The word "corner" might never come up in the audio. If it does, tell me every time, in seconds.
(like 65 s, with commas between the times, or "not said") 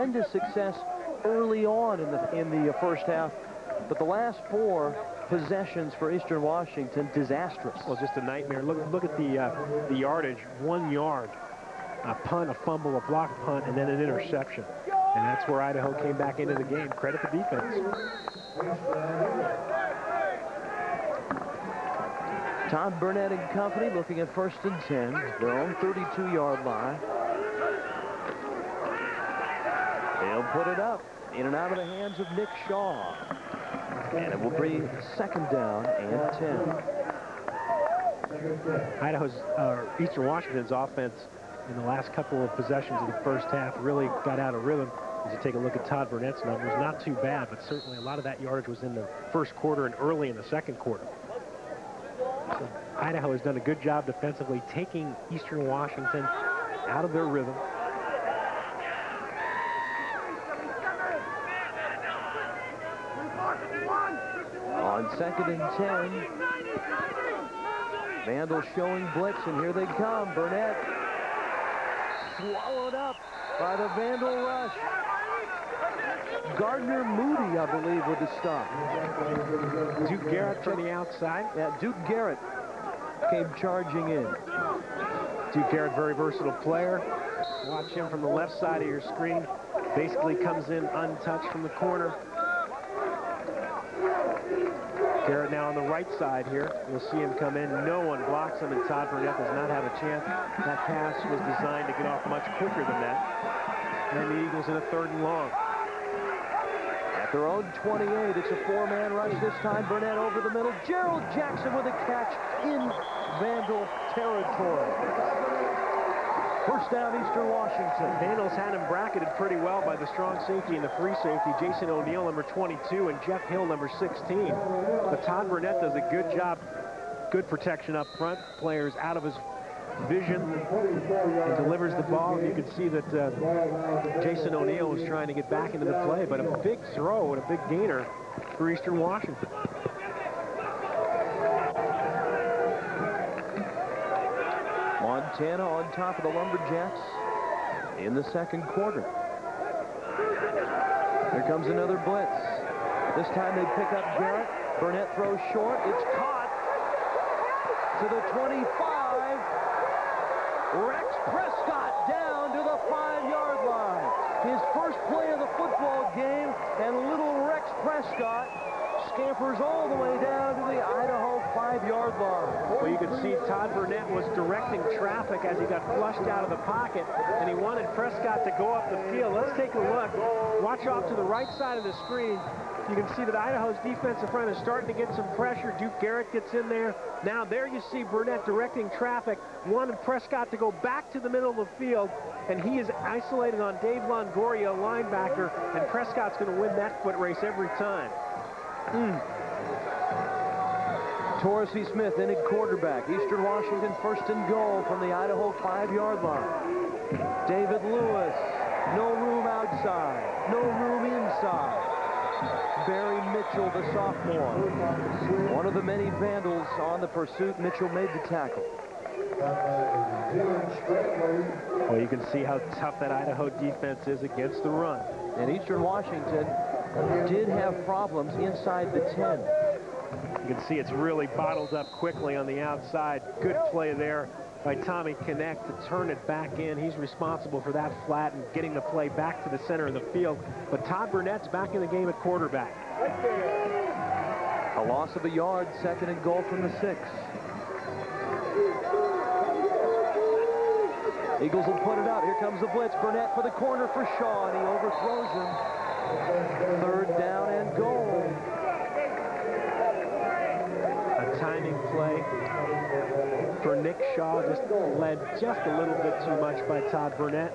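91 s, 253 s.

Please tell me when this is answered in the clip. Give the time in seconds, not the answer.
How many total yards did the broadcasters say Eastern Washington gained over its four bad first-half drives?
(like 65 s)
10 s.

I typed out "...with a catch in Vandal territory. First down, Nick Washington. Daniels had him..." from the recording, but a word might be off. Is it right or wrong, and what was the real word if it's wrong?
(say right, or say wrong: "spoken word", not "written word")
wrong: "Eastern", not "Nick".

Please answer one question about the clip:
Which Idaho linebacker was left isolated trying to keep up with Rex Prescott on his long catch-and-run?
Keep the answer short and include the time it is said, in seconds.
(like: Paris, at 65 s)
Dave Longoria, at 193 s.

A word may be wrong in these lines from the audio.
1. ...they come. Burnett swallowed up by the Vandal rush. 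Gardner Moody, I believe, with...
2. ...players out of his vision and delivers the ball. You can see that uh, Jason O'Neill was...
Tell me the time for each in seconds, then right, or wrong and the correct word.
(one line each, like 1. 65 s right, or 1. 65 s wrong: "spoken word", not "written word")
1. 69 s right
2. 128 s right.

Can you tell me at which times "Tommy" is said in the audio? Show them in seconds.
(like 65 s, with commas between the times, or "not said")
234 s.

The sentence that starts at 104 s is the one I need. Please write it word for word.
And the Eagles in a third and long.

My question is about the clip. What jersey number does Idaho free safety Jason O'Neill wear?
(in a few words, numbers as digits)
22.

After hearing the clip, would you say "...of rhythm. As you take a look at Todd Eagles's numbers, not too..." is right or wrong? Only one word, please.
wrong.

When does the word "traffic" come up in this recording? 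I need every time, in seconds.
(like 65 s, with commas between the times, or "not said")
174 s, 188 s.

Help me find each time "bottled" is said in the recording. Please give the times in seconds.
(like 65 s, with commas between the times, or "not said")
231 s.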